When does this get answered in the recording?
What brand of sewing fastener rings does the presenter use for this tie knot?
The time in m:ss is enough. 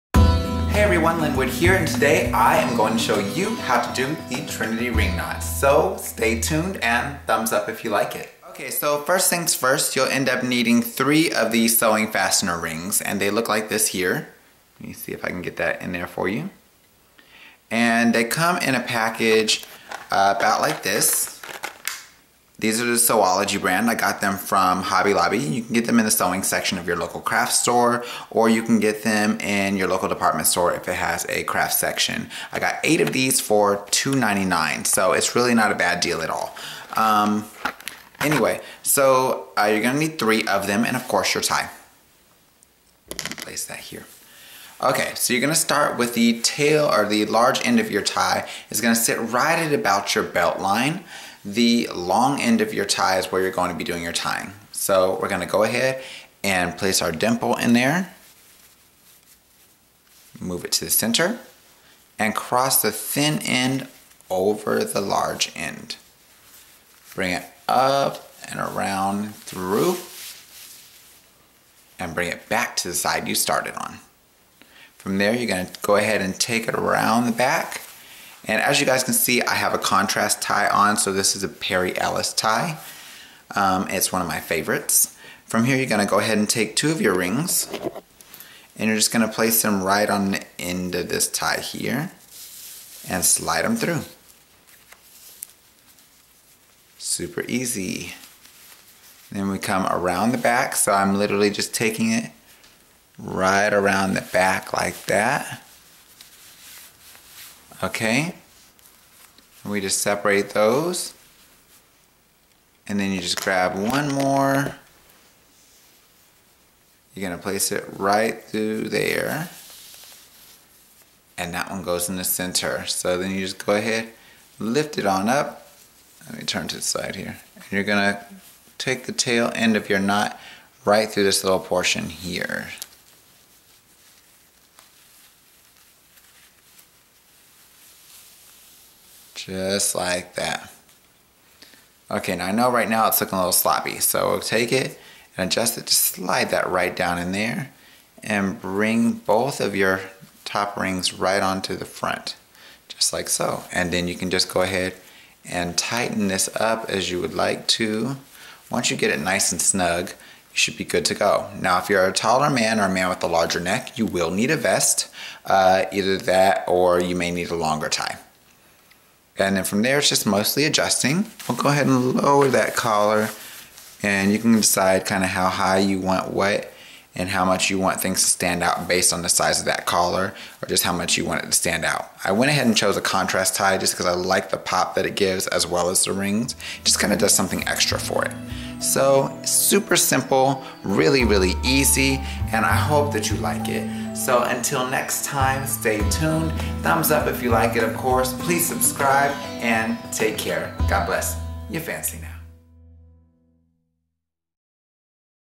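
0:22.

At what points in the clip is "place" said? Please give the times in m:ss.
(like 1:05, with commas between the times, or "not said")
0:43, 0:56, 1:29, 1:57.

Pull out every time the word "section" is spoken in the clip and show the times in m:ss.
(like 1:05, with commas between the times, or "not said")
0:26, 0:31.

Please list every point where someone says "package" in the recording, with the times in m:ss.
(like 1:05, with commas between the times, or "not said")
0:18.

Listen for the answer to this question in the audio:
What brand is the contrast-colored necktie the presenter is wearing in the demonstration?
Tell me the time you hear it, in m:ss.
1:21.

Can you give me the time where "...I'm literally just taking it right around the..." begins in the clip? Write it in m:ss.
1:40.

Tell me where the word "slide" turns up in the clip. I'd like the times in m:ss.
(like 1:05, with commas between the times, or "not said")
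1:33, 2:26.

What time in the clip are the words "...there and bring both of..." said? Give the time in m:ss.
2:27.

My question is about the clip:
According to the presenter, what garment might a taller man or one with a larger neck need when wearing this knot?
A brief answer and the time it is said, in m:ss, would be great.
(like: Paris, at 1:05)
A vest, at 2:44.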